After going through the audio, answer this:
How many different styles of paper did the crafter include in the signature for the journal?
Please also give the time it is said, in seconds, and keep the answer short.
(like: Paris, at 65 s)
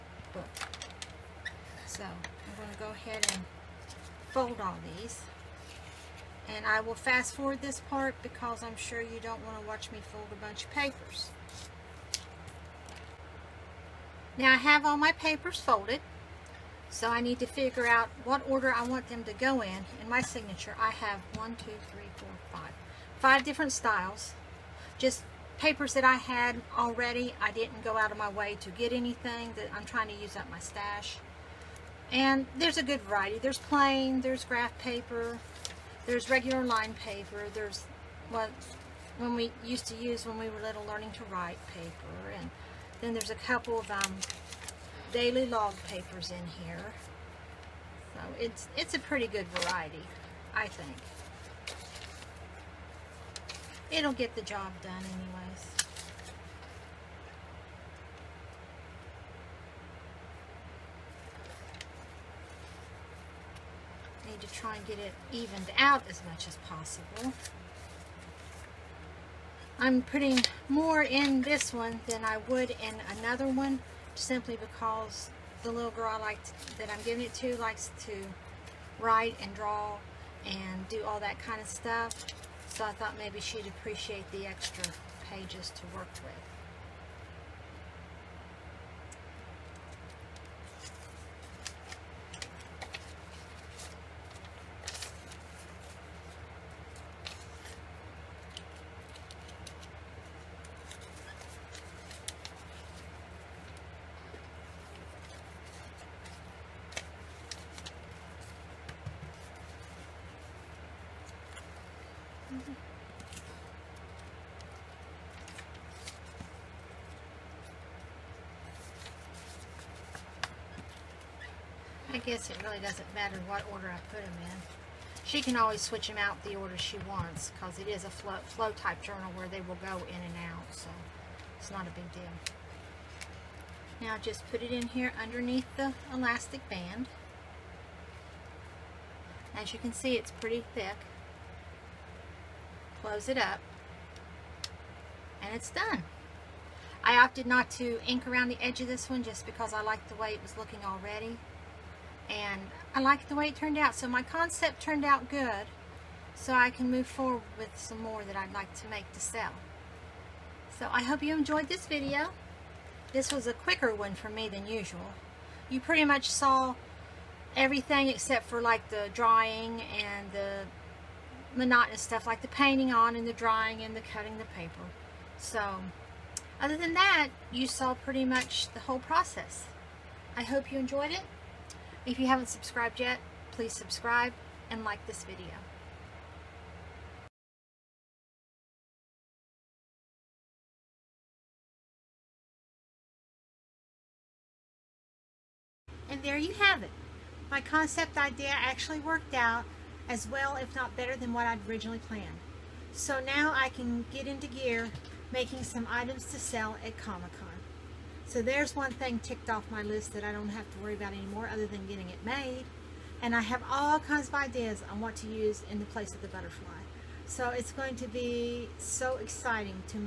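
5, at 23 s.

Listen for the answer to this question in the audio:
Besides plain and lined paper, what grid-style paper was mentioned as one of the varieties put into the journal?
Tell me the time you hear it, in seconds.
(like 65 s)
34 s.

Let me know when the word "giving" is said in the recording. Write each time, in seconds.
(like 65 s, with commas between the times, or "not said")
77 s.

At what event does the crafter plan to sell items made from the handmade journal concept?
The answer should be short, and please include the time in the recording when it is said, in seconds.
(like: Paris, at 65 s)
Comic-Con, at 206 s.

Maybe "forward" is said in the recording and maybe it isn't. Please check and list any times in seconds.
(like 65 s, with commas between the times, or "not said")
7 s, 157 s.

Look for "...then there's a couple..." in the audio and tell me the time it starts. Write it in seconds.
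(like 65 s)
42 s.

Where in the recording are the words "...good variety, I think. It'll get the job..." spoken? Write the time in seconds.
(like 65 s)
49 s.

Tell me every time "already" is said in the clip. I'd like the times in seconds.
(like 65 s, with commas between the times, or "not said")
26 s, 150 s.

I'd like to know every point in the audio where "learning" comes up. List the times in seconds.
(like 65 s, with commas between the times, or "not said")
40 s.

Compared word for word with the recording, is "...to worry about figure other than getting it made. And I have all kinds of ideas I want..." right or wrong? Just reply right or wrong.
wrong.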